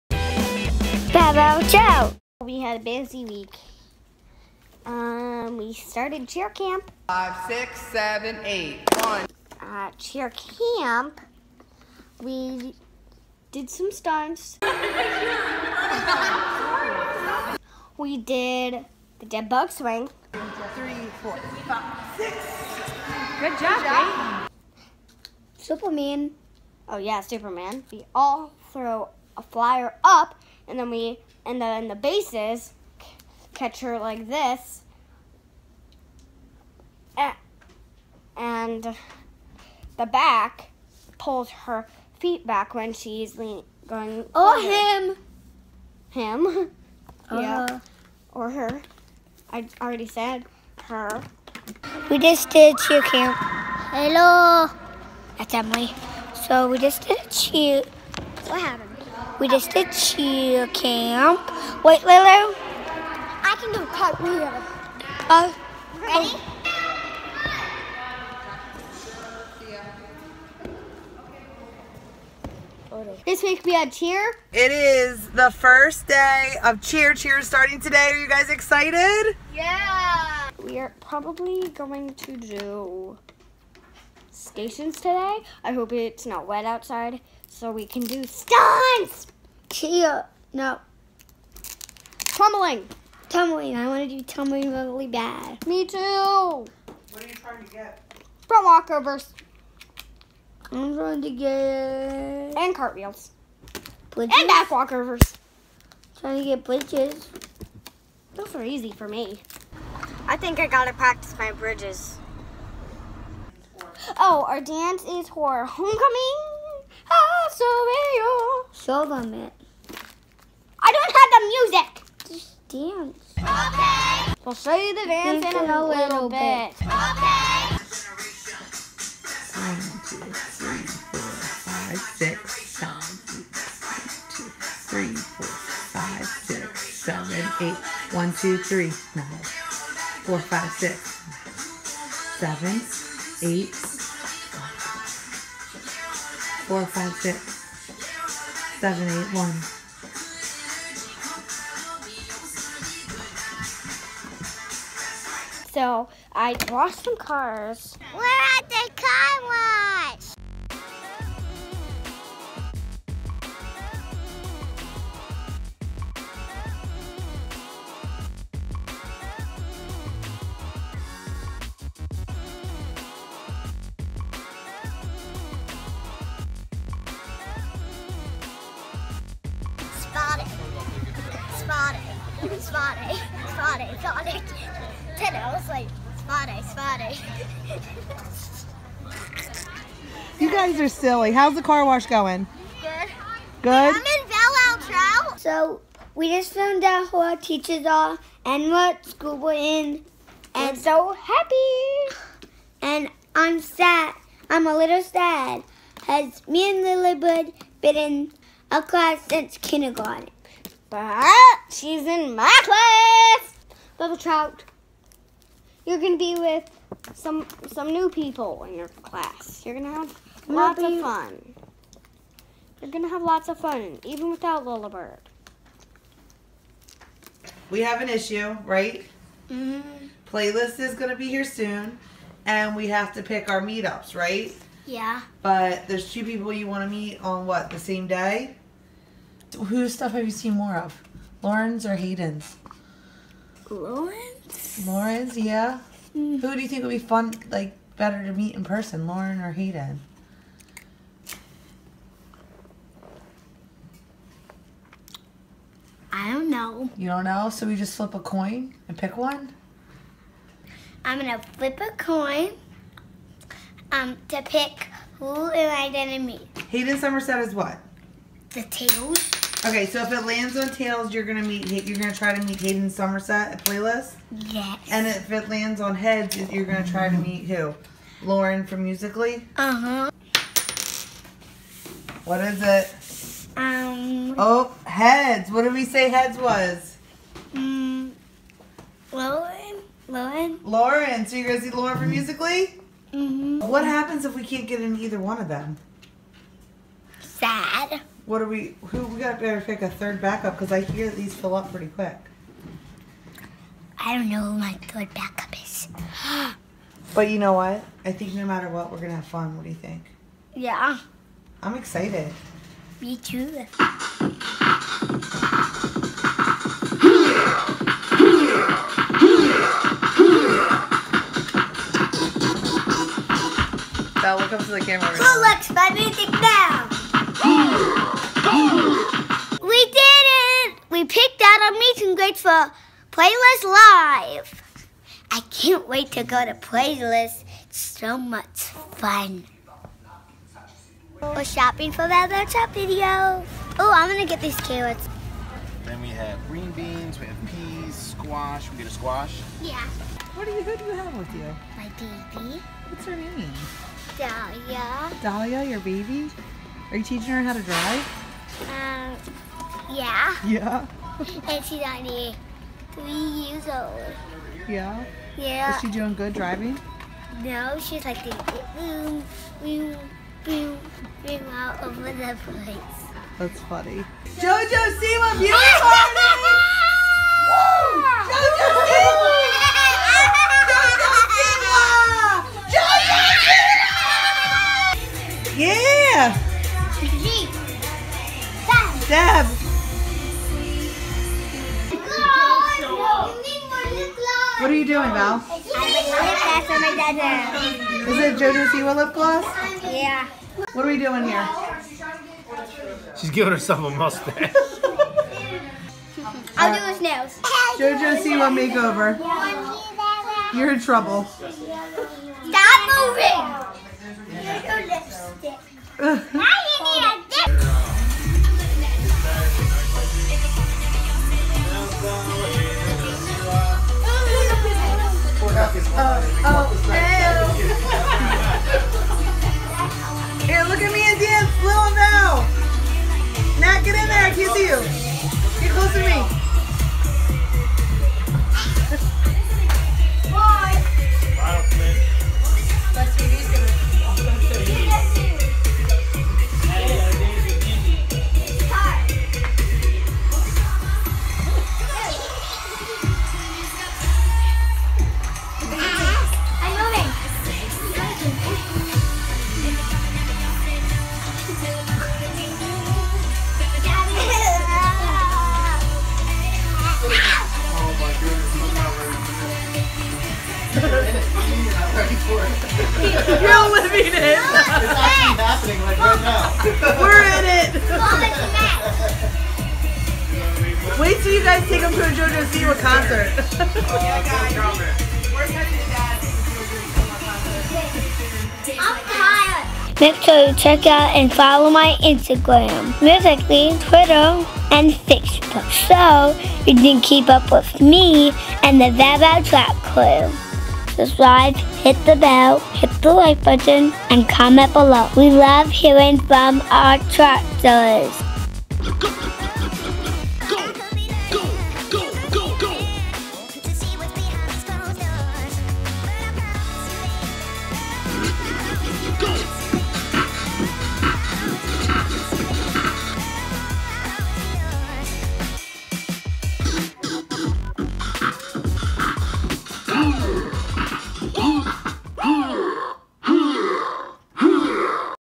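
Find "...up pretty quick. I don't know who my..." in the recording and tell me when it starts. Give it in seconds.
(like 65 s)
301 s.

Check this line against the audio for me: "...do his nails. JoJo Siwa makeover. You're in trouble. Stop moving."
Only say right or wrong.
right.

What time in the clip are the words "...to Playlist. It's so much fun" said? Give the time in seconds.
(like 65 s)
336 s.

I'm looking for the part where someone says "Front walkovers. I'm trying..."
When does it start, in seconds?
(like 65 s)
98 s.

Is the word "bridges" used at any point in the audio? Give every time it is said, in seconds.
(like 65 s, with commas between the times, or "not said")
106 s, 111 s.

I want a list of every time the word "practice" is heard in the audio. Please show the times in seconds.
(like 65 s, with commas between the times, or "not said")
110 s.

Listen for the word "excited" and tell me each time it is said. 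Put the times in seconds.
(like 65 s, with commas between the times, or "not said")
78 s, 311 s.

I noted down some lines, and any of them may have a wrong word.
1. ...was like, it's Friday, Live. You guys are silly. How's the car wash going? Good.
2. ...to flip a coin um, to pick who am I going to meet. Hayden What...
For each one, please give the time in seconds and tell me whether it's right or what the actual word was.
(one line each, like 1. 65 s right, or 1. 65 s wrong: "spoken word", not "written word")
1. 185 s wrong: "Friday", not "Live"
2. 261 s wrong: "Summerall", not "What".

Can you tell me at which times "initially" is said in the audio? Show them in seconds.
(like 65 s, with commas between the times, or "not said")
not said.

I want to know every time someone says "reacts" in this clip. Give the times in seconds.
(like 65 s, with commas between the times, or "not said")
not said.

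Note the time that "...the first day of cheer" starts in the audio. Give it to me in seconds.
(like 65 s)
75 s.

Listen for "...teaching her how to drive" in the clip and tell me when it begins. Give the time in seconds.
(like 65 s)
357 s.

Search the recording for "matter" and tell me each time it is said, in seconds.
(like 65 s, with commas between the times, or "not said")
308 s.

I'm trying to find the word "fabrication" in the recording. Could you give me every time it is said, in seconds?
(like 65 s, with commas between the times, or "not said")
not said.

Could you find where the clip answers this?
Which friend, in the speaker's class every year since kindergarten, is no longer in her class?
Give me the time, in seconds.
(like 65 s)
206 s.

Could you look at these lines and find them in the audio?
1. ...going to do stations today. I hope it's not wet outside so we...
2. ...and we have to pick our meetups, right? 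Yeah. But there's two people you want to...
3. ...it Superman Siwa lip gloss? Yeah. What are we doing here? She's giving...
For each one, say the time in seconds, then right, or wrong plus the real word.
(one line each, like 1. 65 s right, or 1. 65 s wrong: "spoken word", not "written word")
1. 81 s right
2. 232 s right
3. 398 s wrong: "JoJo", not "Superman".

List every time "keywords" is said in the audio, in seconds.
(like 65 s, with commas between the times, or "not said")
not said.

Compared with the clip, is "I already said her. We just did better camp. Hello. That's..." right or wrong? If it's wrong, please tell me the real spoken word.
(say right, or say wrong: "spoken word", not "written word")
wrong: "cheer", not "better".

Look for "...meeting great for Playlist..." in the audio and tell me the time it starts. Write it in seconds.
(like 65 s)
331 s.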